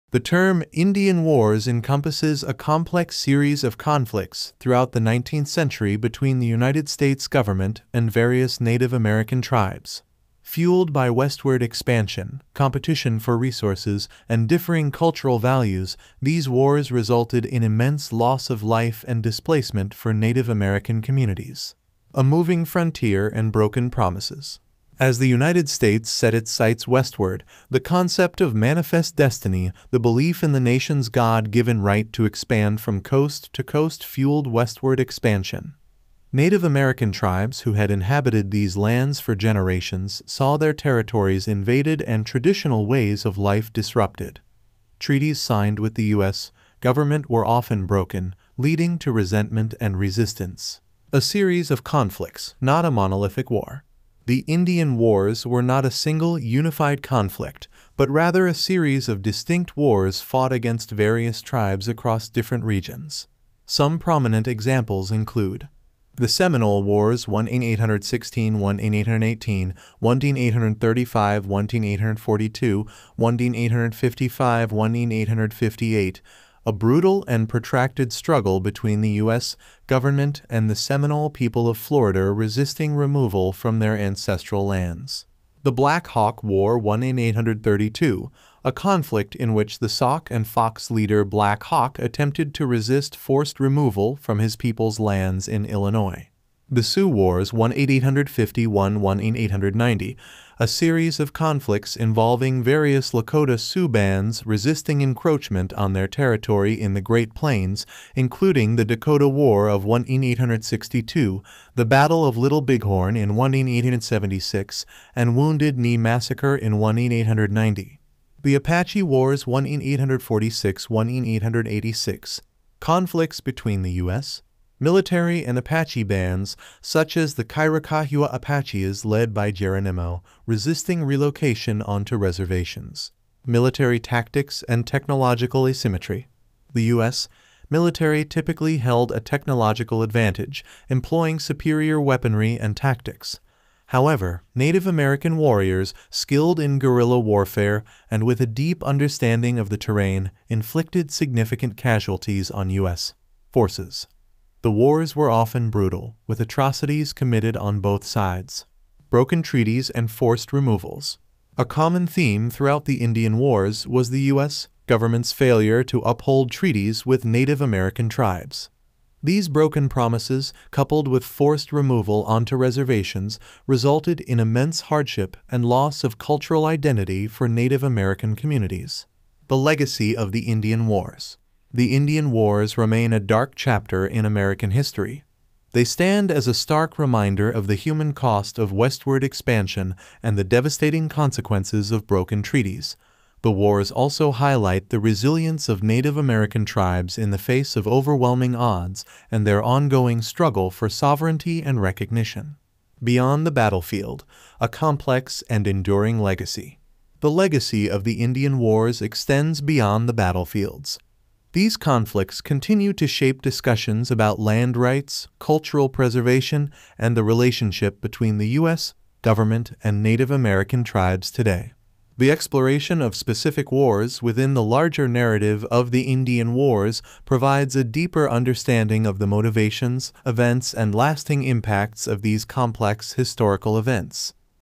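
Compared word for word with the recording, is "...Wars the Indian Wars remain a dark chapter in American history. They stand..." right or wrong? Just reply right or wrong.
right.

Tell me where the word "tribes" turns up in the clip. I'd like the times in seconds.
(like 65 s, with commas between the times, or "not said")
9 s, 37 s, 168 s, 196 s, 220 s.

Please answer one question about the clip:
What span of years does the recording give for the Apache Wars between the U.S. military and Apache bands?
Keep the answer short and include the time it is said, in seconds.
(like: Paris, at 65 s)
1846-1886, at 119 s.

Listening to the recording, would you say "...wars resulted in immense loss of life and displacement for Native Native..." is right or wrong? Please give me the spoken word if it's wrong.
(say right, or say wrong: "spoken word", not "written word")
wrong: "American", not "Native".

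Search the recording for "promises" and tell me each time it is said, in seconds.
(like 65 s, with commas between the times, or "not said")
23 s, 169 s.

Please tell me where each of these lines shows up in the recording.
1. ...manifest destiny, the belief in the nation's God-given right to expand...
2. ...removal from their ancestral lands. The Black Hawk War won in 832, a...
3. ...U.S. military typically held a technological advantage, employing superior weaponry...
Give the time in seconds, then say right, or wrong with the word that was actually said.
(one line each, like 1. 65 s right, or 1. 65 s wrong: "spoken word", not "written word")
1. 28 s right
2. 82 s right
3. 136 s right.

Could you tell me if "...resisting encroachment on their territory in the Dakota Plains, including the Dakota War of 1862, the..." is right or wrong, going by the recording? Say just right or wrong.
wrong.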